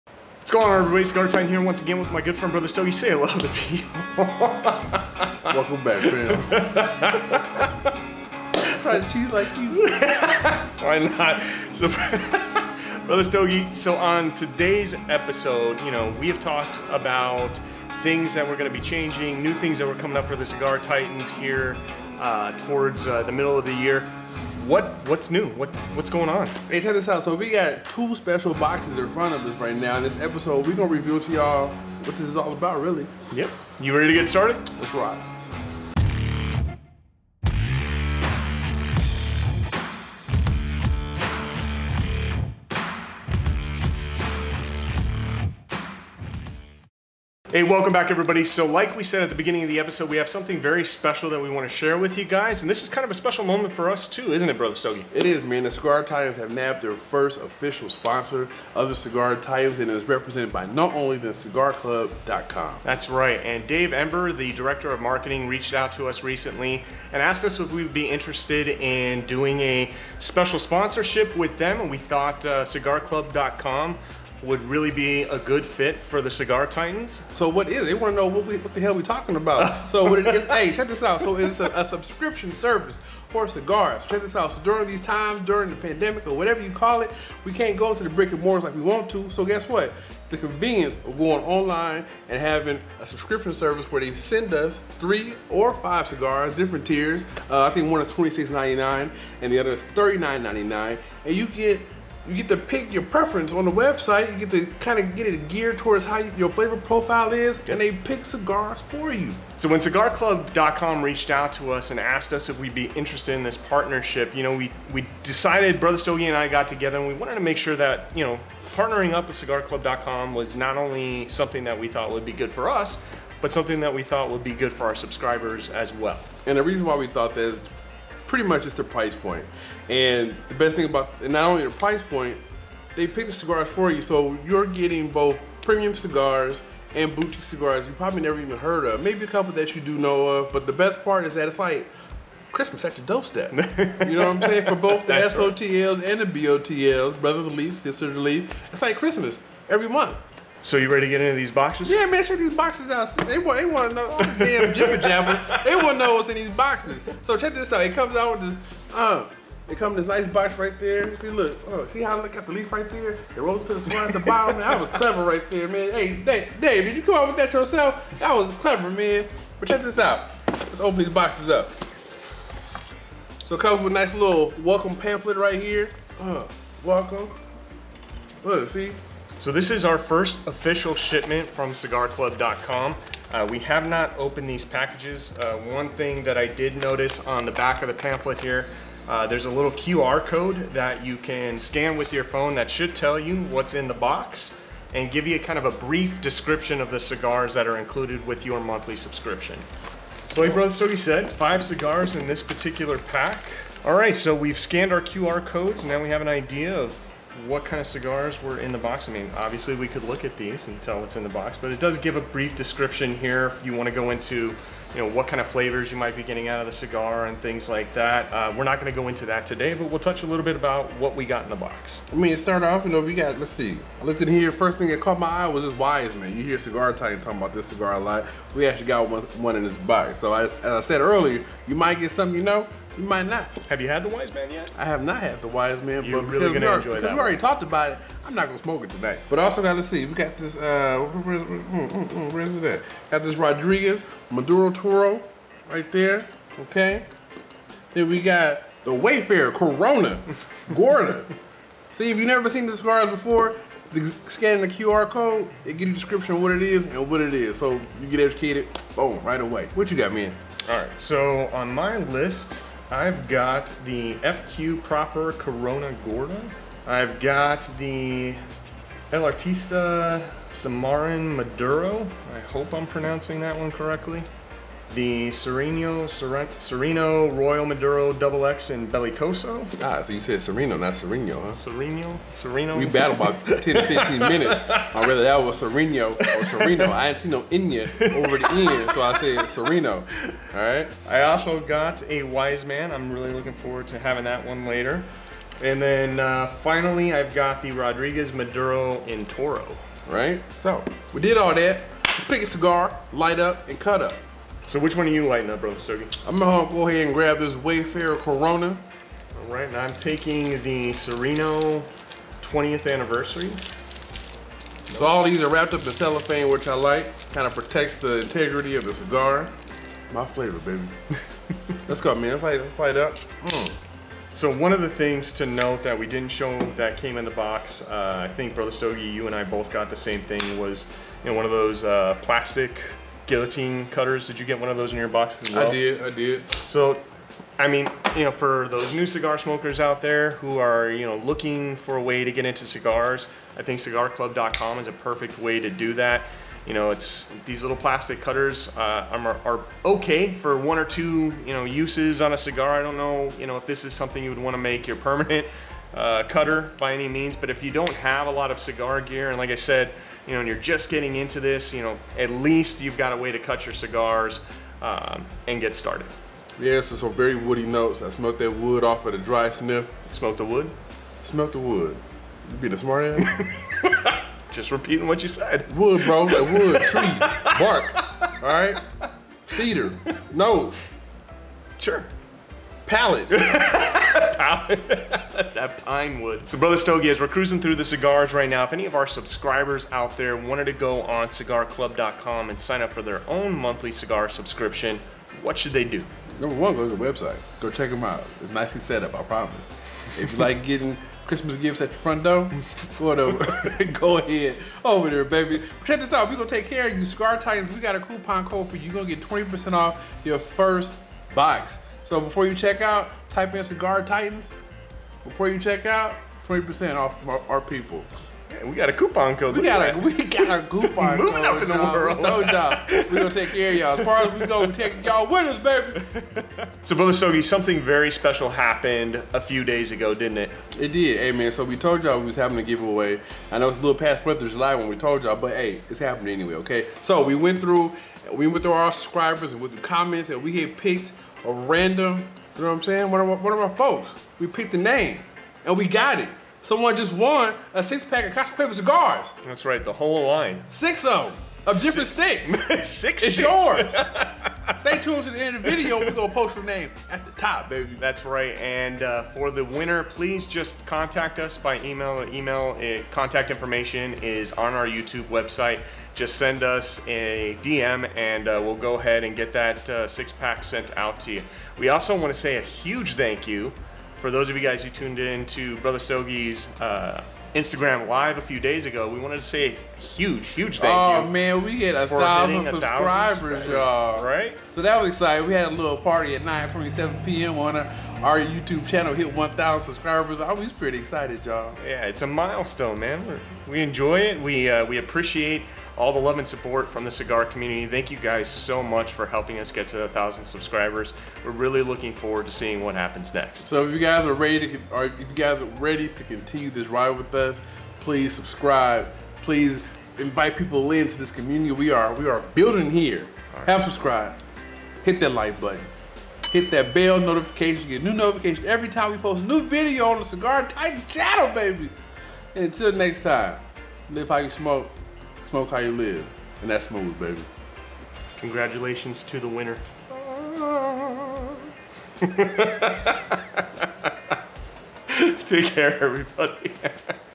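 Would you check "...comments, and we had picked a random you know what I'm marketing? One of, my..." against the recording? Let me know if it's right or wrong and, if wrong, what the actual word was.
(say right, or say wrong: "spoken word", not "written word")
wrong: "saying", not "marketing".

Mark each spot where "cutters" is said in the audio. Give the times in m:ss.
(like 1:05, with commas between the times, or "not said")
5:33, 5:48, 5:56.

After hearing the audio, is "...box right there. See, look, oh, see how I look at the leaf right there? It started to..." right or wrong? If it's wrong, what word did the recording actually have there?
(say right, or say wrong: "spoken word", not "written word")
wrong: "rolled", not "started".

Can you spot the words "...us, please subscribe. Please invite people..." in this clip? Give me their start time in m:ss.
8:27.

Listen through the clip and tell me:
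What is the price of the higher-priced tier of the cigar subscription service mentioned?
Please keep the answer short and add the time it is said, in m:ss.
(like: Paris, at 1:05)
$39.99, at 1:39.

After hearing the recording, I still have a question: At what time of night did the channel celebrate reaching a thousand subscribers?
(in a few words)
9:47 p.m.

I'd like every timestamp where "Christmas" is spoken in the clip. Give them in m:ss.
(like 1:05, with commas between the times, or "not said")
2:22, 2:28, 6:41.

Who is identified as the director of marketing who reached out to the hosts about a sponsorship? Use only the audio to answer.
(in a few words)
Dave Ember.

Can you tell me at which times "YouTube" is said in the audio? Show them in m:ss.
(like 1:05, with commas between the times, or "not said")
7:44, 8:08.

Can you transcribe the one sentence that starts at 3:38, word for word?
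Uh, we're not going to go into that today, but we'll touch a little bit about what we got in the box.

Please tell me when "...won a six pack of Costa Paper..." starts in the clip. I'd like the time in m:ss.
7:27.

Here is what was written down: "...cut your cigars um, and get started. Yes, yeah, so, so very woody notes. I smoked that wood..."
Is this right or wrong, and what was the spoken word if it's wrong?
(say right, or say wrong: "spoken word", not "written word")
right.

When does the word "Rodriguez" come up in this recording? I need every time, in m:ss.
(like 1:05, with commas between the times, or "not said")
4:03, 4:57.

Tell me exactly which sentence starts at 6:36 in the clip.
Number one, go to the website.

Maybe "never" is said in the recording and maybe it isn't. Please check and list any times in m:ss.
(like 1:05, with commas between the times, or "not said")
2:18, 4:12.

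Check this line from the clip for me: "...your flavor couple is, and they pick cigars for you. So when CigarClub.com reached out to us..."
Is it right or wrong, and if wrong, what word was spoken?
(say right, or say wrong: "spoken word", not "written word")
wrong: "profile", not "couple".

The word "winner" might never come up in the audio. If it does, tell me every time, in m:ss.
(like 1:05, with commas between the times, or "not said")
7:39, 8:49.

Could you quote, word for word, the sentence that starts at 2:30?
So you ready to get into these boxes?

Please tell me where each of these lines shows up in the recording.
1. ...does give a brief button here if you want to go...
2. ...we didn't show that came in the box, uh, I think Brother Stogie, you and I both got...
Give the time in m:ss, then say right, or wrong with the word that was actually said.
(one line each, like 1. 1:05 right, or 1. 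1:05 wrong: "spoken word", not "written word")
1. 3:31 wrong: "description", not "button"
2. 5:25 right.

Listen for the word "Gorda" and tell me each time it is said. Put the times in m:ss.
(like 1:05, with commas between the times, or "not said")
4:10, 4:26.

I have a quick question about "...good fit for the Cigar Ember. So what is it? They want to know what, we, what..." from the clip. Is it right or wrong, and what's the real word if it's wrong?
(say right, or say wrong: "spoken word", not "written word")
wrong: "Titans", not "Ember".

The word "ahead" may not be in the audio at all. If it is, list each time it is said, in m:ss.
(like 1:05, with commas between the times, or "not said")
5:06, 6:44, 7:48.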